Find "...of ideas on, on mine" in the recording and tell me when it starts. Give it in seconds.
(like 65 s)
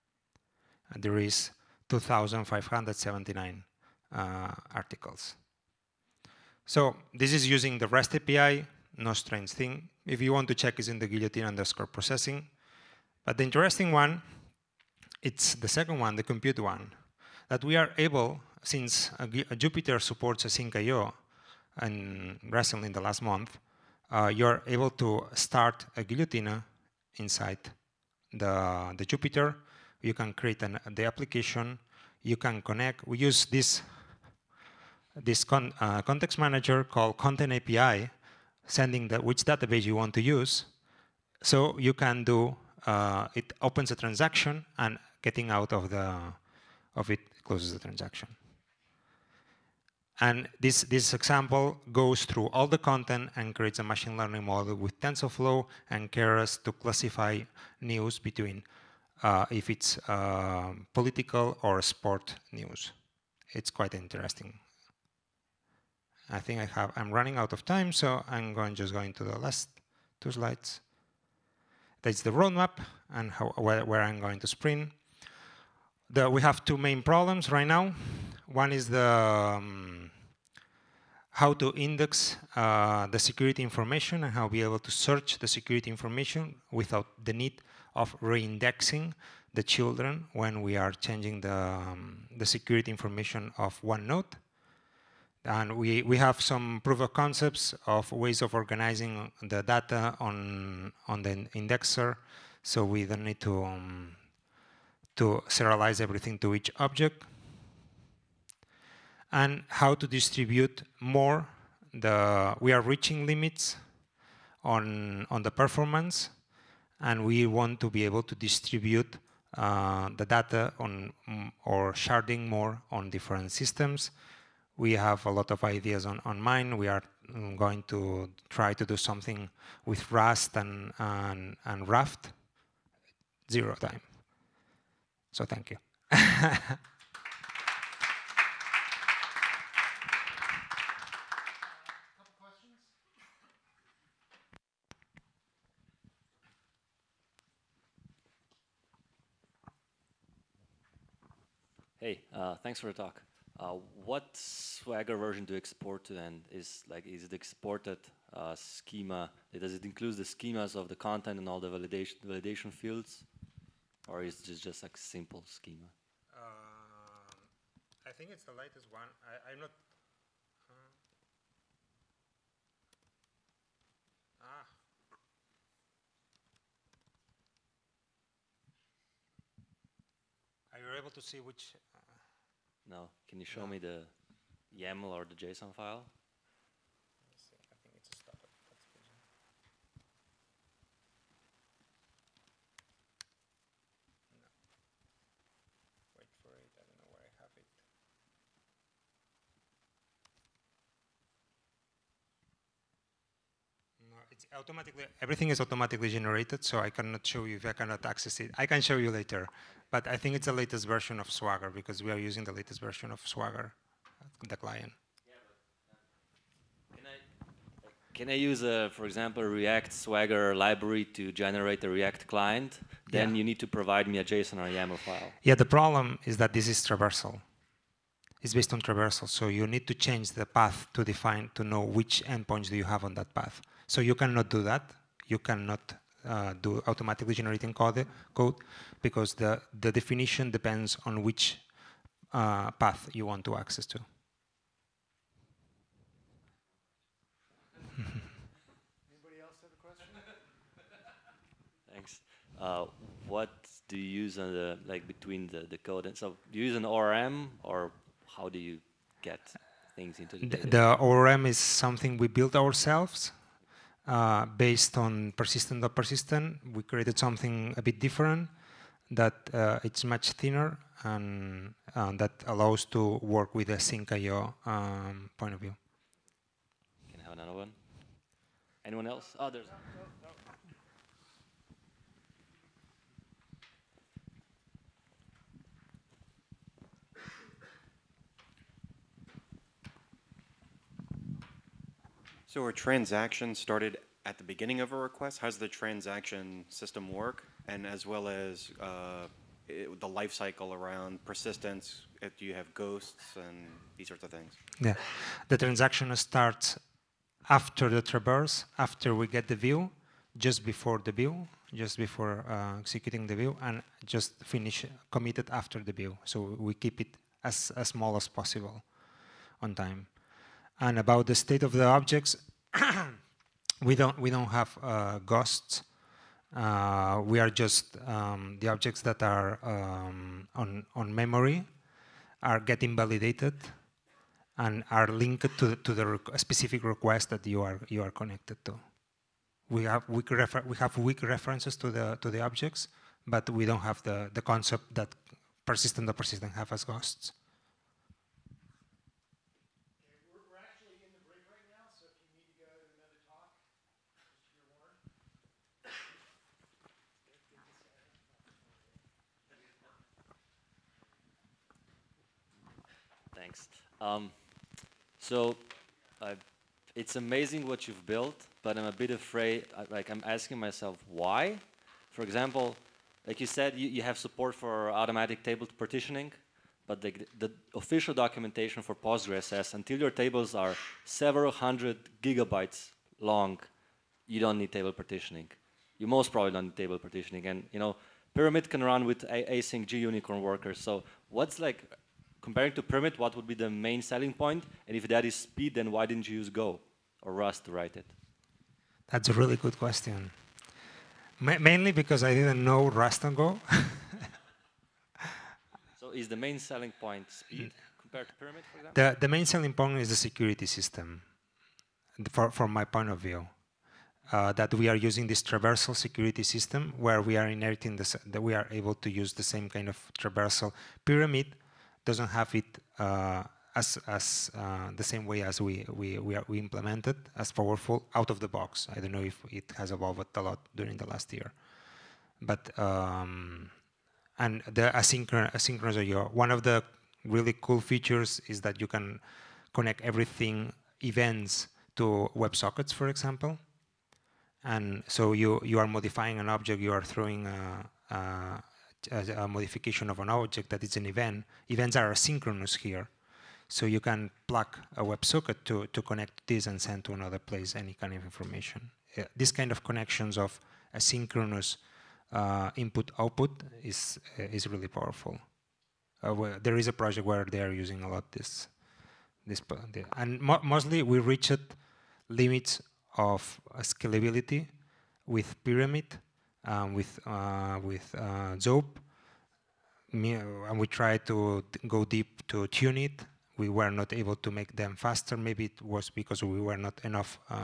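125 s.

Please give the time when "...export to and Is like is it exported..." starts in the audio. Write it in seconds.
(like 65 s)
155 s.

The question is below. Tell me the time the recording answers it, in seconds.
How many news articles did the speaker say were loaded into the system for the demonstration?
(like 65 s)
1 s.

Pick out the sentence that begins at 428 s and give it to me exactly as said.
I don't know if it has evolved a lot during the last year.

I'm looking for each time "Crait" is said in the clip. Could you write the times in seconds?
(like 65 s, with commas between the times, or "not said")
not said.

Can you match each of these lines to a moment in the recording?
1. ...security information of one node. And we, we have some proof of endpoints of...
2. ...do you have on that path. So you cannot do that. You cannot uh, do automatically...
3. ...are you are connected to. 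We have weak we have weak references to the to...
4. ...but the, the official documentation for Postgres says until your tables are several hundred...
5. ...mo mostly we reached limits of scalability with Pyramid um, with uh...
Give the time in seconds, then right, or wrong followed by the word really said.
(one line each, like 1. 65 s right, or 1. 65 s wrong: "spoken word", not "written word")
1. 92 s wrong: "concepts", not "endpoints"
2. 232 s right
3. 337 s right
4. 376 s right
5. 470 s right.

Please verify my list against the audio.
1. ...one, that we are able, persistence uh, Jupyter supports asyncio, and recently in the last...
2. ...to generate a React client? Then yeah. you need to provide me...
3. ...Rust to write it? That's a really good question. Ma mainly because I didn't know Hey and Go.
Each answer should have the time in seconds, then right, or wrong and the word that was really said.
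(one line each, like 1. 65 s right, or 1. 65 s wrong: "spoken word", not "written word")
1. 16 s wrong: "since", not "persistence"
2. 221 s right
3. 397 s wrong: "Rust", not "Hey".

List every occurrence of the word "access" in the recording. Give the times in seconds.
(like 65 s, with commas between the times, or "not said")
208 s, 243 s.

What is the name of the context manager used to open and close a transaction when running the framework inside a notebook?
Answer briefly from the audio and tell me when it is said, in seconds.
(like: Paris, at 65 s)
Content API, at 37 s.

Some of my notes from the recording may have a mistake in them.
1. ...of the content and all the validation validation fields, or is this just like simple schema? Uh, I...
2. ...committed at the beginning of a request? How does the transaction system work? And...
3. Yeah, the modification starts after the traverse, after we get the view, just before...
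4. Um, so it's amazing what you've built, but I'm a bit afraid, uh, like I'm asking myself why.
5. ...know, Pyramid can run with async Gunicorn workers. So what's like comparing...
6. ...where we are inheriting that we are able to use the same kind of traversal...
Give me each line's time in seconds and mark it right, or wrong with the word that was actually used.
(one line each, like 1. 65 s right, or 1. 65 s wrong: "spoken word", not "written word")
1. 160 s right
2. 293 s wrong: "started", not "committed"
3. 304 s wrong: "transaction", not "modification"
4. 364 s right
5. 387 s right
6. 416 s right.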